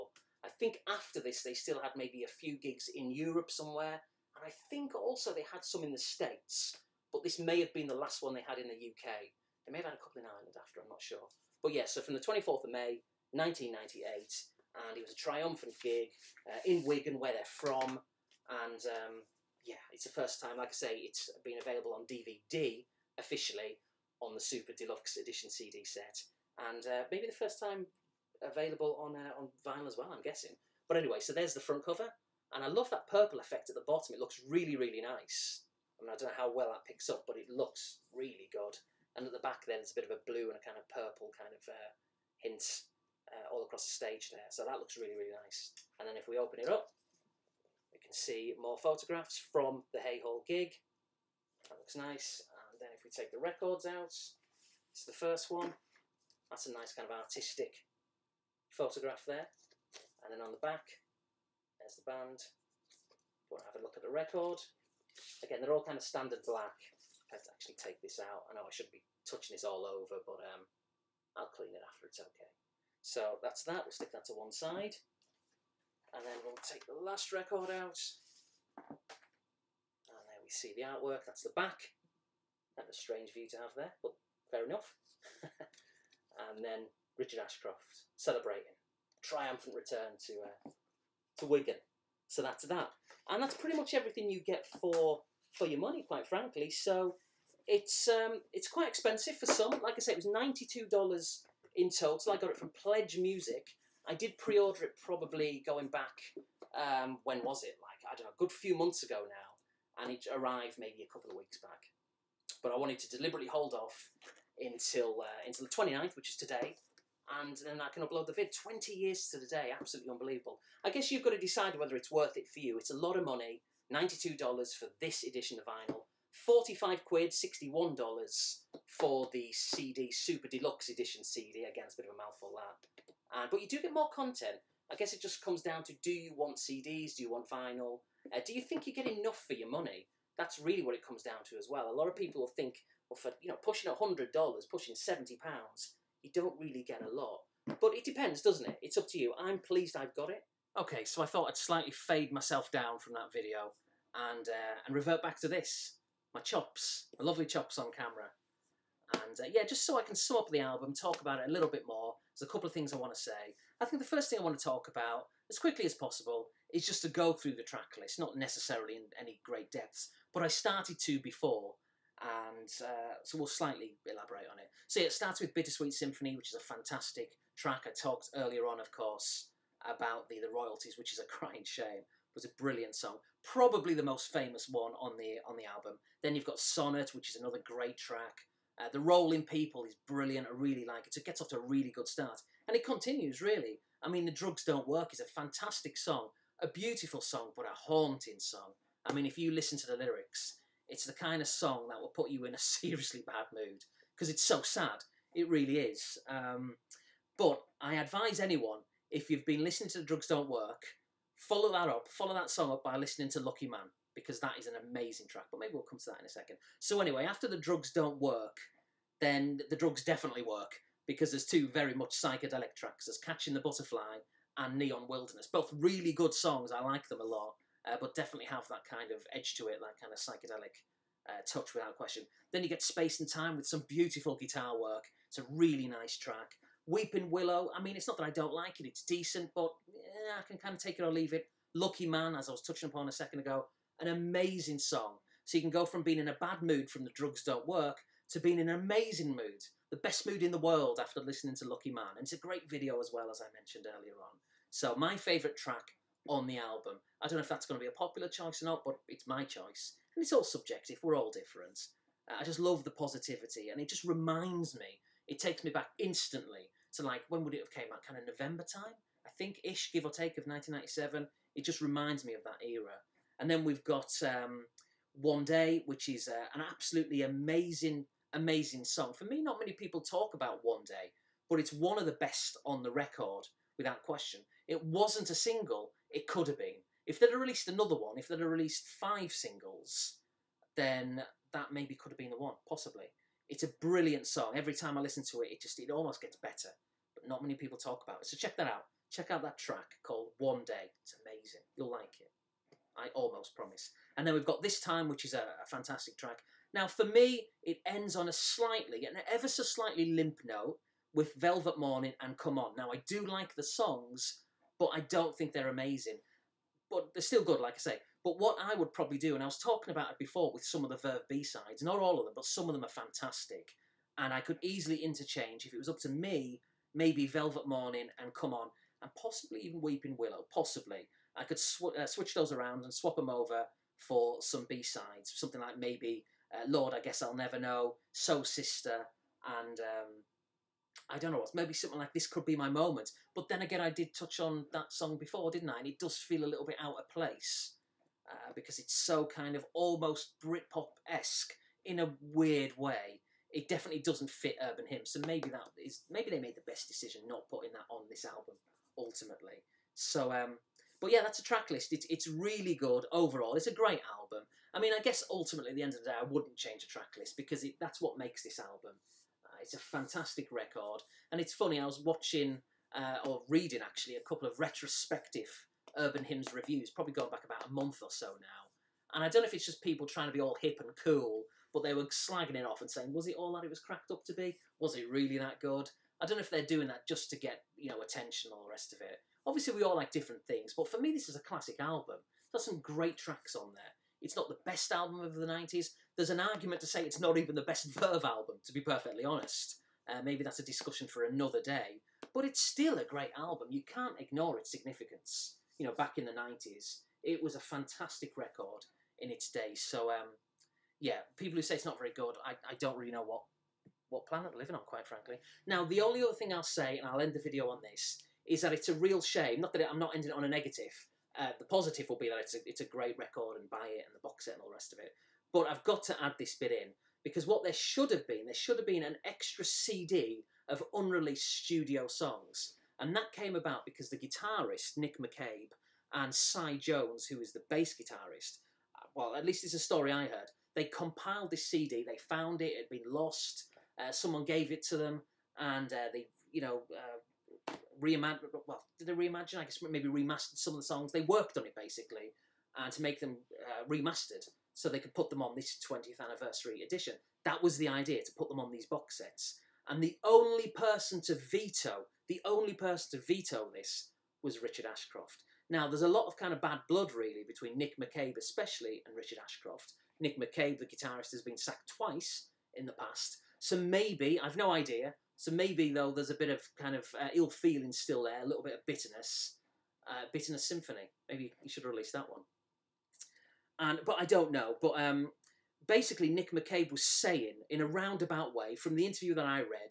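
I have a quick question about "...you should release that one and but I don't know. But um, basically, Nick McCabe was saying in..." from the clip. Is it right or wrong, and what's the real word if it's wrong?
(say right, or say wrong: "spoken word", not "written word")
right.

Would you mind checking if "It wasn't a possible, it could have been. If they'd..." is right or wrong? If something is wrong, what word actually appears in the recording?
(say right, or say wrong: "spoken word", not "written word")
wrong: "single", not "possible".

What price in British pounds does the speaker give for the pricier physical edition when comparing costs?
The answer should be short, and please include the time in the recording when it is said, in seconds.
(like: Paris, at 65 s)
45 quid, at 126 s.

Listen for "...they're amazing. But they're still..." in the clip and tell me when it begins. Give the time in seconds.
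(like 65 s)
315 s.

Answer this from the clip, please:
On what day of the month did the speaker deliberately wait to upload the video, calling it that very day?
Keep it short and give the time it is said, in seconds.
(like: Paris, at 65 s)
29th, at 115 s.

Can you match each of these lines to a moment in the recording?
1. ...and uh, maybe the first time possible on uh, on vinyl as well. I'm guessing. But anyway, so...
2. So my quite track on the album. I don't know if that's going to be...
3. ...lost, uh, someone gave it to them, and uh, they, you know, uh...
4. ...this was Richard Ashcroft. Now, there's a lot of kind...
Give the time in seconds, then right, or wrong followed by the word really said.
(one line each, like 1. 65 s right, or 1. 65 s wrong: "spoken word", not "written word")
1. 26 s wrong: "available", not "possible"
2. 254 s wrong: "favourite", not "quite"
3. 443 s right
4. 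463 s right.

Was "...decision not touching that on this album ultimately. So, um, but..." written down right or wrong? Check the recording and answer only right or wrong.
wrong.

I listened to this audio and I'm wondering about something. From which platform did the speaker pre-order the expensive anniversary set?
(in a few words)
PledgeMusic.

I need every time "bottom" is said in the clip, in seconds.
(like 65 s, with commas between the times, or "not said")
33 s.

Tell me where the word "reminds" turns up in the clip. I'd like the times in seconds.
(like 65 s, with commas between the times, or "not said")
264 s, 271 s.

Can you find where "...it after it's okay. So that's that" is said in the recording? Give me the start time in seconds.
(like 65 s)
71 s.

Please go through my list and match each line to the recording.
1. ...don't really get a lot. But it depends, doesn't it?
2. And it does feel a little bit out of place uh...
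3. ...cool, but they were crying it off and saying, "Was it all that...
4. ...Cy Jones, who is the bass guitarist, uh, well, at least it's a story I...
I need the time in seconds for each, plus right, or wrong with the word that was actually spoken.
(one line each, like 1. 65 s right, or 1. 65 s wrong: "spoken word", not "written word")
1. 146 s right
2. 345 s right
3. 381 s wrong: "slagging", not "crying"
4. 436 s right.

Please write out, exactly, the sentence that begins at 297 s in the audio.
But not many people talk about it.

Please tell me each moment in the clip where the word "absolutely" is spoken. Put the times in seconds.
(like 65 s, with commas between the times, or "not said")
119 s, 276 s.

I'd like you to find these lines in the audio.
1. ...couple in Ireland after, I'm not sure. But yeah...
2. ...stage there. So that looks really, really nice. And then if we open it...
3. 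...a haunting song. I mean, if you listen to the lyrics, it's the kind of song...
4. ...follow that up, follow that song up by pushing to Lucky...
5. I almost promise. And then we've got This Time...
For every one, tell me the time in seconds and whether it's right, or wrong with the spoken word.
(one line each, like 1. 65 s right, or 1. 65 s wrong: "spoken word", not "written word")
1. 10 s right
2. 43 s right
3. 197 s right
4. 211 s wrong: "listening", not "pushing"
5. 302 s right.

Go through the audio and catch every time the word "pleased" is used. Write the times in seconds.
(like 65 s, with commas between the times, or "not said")
149 s.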